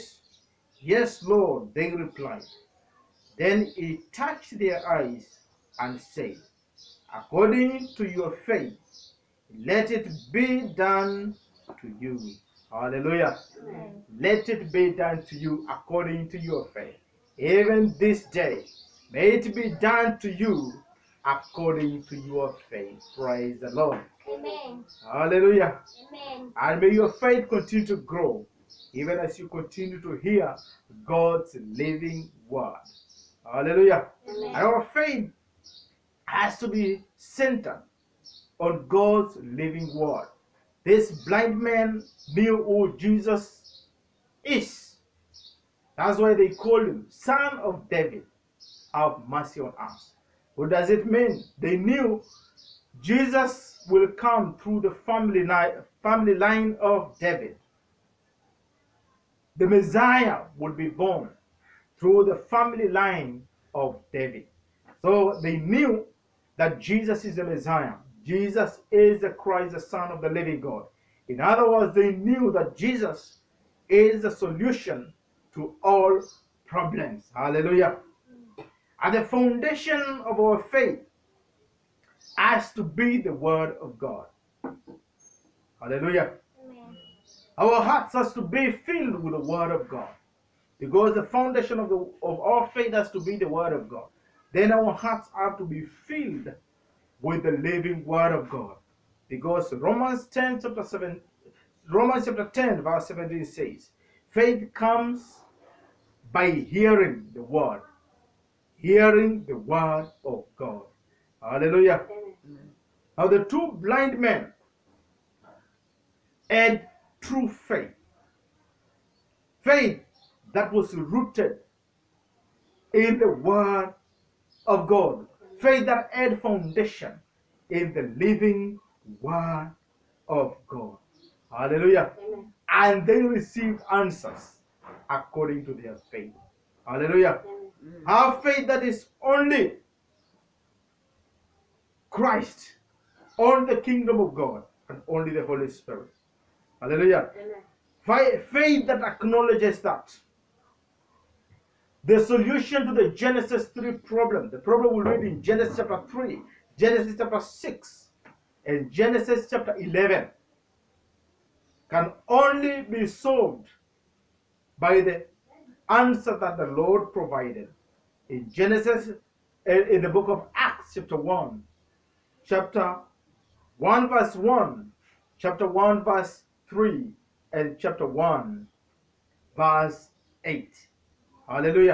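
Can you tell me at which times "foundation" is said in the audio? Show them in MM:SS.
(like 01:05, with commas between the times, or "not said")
01:19, 01:31, 02:06.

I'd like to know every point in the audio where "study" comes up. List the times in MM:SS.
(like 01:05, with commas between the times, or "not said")
not said.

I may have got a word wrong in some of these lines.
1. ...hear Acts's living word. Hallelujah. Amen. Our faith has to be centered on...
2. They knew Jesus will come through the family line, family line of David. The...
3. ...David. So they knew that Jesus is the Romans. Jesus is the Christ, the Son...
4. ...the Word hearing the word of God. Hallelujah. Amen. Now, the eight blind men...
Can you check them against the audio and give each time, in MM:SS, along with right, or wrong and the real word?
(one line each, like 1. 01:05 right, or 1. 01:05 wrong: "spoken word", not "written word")
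1. 00:30 wrong: "God", not "Acts"
2. 00:51 right
3. 01:04 wrong: "Messiah", not "Romans"
4. 01:47 wrong: "two", not "eight".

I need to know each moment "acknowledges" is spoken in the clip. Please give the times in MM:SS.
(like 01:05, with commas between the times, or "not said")
02:29.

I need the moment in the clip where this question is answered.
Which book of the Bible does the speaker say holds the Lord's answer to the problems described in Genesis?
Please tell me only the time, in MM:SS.
02:50.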